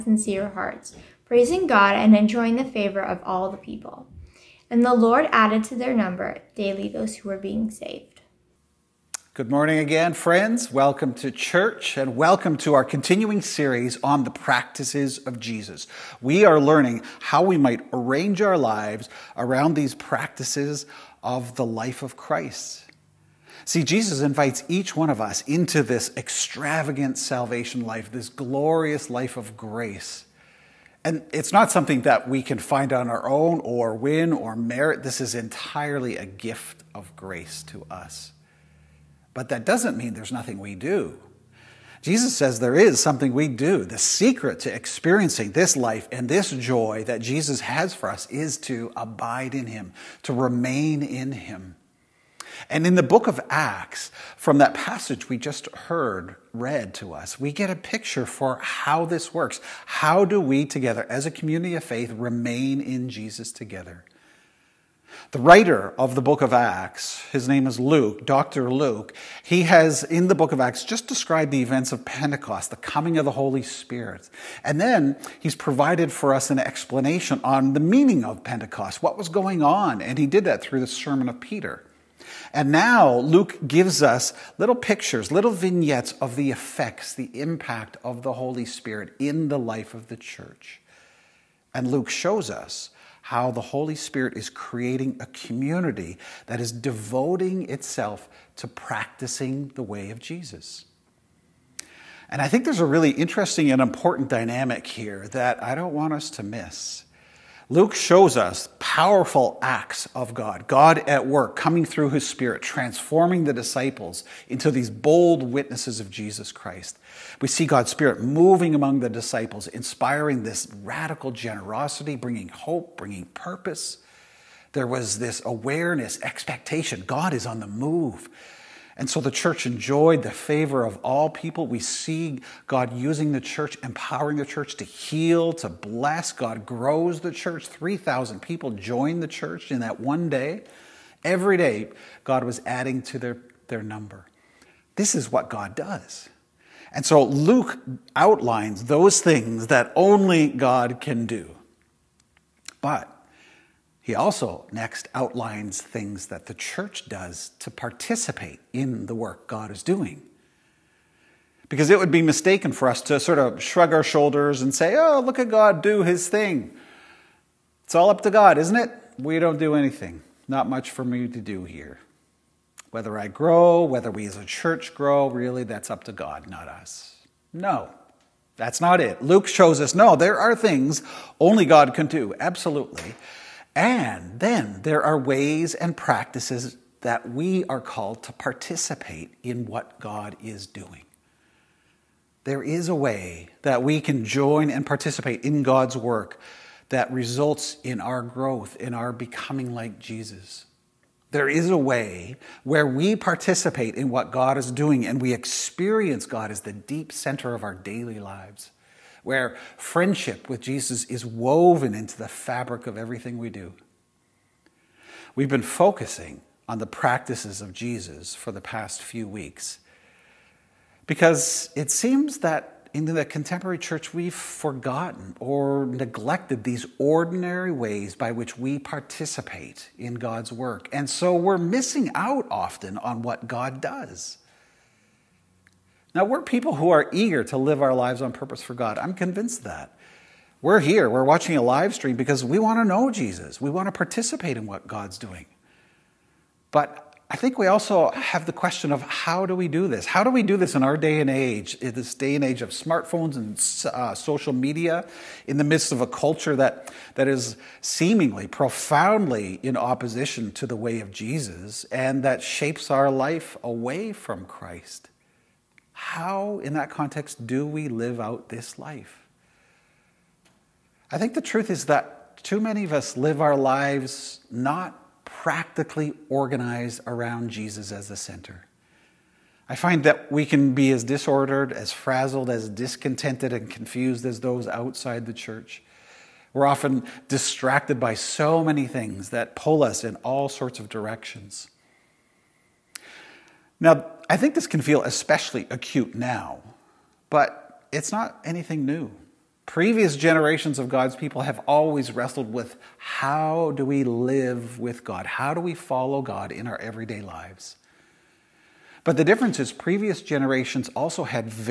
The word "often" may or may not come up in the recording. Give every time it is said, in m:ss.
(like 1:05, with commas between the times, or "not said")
3:52, 4:46.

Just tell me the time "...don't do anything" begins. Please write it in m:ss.
2:49.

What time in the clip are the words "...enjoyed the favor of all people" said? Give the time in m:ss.
2:09.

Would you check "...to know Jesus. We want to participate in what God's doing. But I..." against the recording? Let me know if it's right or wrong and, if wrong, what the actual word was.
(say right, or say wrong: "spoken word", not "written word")
right.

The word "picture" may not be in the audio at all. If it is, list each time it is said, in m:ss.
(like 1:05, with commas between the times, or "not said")
0:57, 1:24.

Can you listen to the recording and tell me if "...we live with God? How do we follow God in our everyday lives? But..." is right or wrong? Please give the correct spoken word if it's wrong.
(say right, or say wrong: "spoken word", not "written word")
right.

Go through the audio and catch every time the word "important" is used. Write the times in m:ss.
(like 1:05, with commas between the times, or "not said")
1:43.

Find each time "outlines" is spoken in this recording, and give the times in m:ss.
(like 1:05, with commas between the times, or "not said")
2:28, 2:35.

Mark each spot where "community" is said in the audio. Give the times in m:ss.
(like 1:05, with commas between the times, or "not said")
1:01, 1:35.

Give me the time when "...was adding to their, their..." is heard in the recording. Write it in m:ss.
2:22.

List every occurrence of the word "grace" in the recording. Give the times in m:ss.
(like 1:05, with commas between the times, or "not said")
0:29, 0:37.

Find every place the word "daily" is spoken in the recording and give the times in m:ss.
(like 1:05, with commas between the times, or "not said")
0:06, 3:27.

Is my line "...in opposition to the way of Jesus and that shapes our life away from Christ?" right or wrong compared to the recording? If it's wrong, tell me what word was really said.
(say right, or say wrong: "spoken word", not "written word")
right.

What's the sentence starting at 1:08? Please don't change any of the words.
Luke, he has in the book of Acts just described the events of Pentecost, the coming of the Holy Spirit.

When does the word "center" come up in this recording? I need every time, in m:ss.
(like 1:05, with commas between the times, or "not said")
3:27, 4:38.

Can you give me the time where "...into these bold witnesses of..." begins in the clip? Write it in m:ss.
1:54.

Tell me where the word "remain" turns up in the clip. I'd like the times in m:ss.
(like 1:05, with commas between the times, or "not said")
0:50, 1:02.